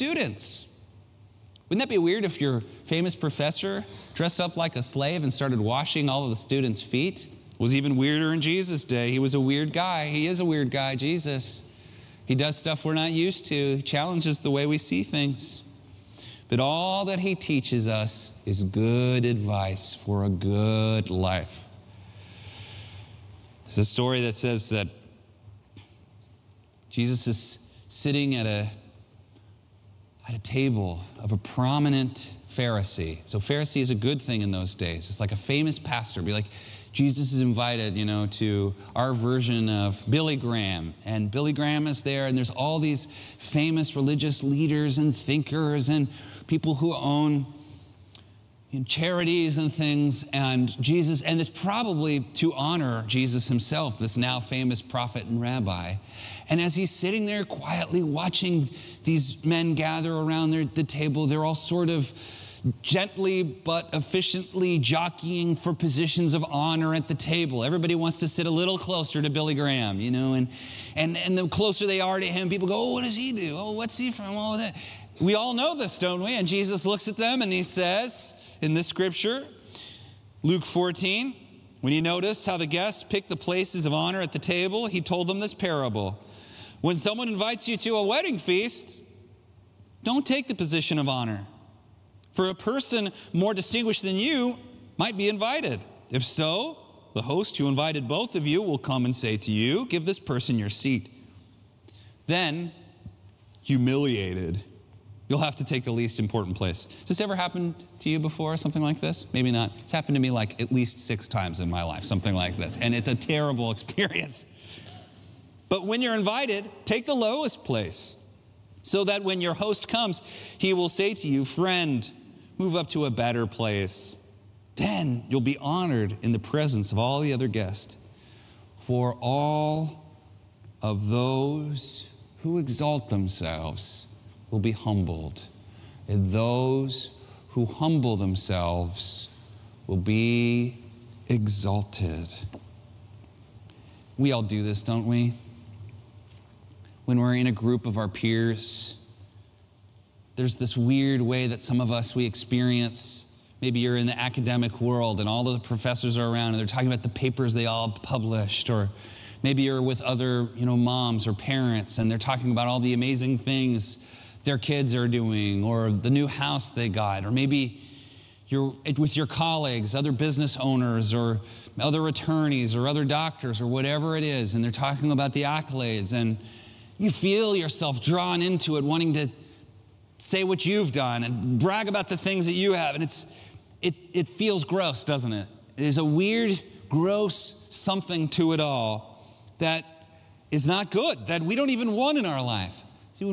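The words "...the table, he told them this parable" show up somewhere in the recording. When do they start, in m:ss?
1:24.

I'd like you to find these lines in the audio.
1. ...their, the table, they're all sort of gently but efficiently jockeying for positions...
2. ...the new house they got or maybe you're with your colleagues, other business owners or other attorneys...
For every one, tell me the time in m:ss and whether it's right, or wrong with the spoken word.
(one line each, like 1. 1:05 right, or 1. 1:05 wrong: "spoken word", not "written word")
1. 1:00 right
2. 2:45 right.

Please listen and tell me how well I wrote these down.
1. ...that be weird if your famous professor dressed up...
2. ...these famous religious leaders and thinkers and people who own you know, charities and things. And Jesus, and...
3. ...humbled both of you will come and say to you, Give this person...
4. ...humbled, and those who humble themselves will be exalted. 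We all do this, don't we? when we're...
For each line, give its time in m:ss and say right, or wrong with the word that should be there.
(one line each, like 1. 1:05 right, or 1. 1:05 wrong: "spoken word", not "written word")
1. 0:01 right
2. 0:42 right
3. 1:37 wrong: "invited", not "humbled"
4. 2:14 right.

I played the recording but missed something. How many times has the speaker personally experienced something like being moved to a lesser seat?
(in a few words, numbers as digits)
6.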